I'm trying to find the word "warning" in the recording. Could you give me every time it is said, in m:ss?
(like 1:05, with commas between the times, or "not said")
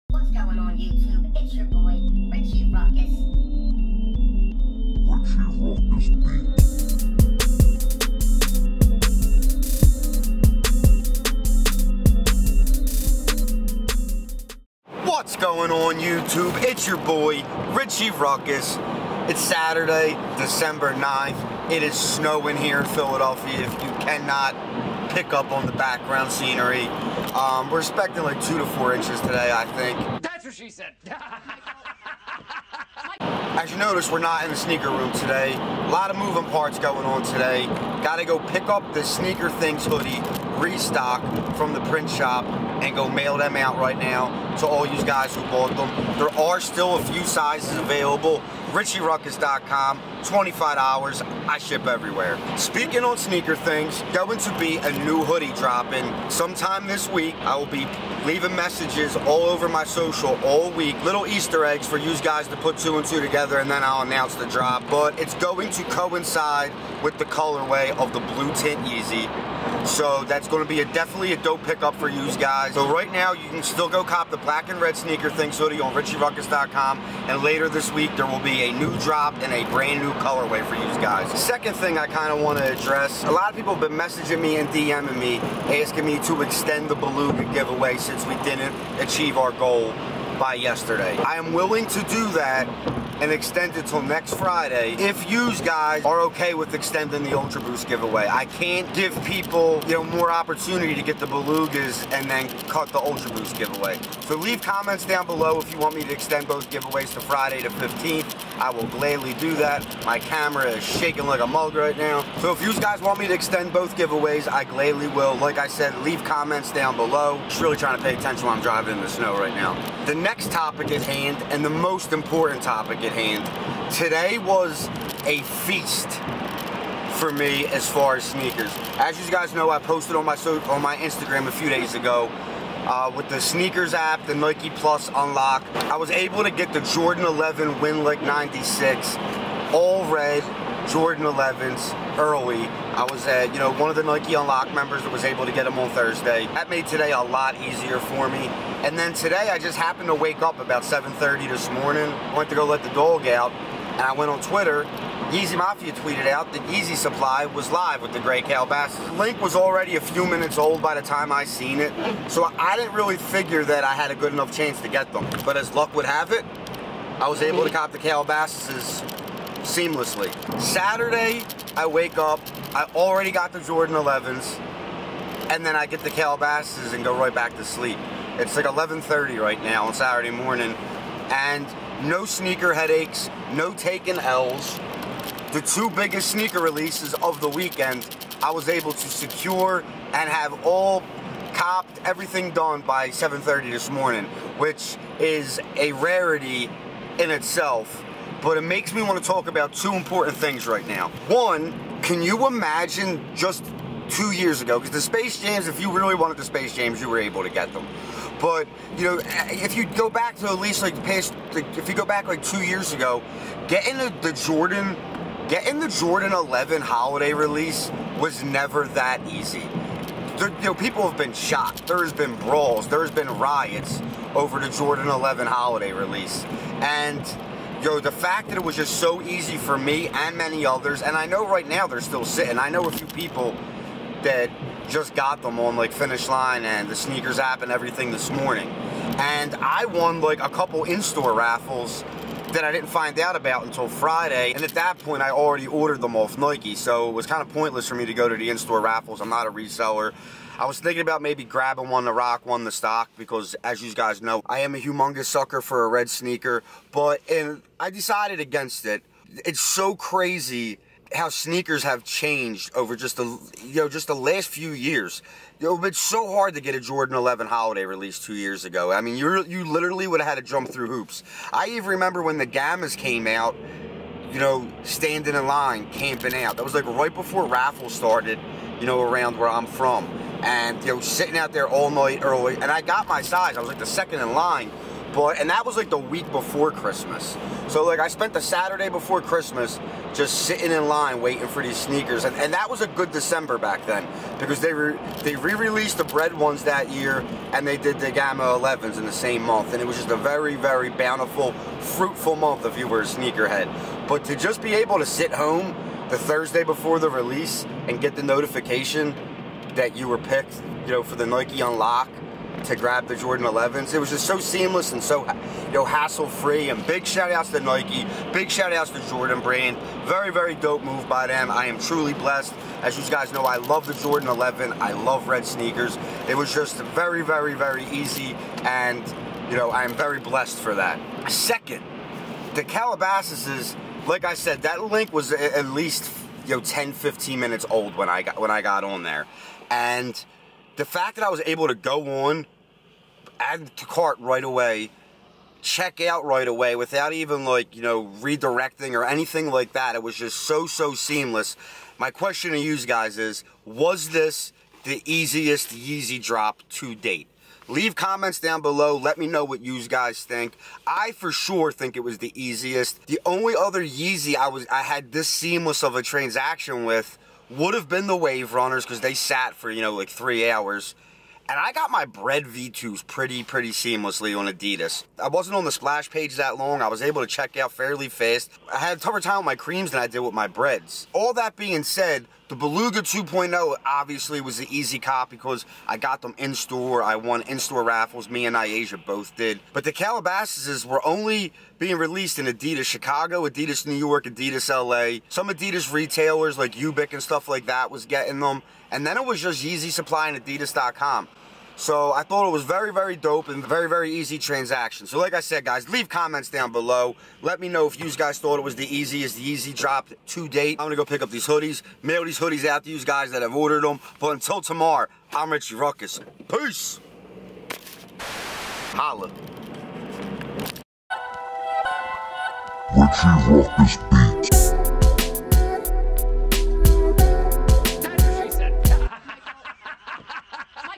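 not said.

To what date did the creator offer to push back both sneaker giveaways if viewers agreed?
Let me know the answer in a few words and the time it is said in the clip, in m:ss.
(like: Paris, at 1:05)
Friday the 15th, at 1:47.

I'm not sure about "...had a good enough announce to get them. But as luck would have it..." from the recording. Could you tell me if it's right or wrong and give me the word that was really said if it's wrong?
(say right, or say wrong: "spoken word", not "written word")
wrong: "chance", not "announce".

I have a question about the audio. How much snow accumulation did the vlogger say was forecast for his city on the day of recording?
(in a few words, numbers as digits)
2 to 4 inches.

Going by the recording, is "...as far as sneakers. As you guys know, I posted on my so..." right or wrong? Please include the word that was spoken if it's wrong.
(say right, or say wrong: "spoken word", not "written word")
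right.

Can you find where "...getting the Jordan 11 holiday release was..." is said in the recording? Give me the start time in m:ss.
3:35.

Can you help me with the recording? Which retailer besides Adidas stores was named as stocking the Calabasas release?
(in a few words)
Ubiq.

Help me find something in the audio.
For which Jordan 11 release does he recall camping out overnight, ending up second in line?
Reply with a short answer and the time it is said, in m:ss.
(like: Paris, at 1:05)
Gamma, at 4:32.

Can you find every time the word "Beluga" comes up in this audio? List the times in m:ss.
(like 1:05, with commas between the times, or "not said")
1:26, 1:41, 6:22.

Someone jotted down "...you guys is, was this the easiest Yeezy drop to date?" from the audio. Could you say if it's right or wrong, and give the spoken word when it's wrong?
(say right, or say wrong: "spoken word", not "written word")
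right.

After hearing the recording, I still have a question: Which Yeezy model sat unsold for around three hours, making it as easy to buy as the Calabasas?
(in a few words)
Wave Runners.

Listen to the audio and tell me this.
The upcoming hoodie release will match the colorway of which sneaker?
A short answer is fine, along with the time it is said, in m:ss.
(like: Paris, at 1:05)
blue tint Yeezy, at 1:08.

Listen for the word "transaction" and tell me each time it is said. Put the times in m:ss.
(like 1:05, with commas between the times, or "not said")
6:06, 6:44.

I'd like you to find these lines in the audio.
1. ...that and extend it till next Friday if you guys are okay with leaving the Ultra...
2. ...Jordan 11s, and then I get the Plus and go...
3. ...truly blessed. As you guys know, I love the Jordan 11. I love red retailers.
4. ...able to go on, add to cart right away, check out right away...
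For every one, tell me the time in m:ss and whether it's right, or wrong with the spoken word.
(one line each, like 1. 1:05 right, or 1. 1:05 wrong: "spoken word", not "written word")
1. 1:32 wrong: "extending", not "leaving"
2. 2:53 wrong: "Calabasas", not "Plus"
3. 5:21 wrong: "sneakers", not "retailers"
4. 5:41 right.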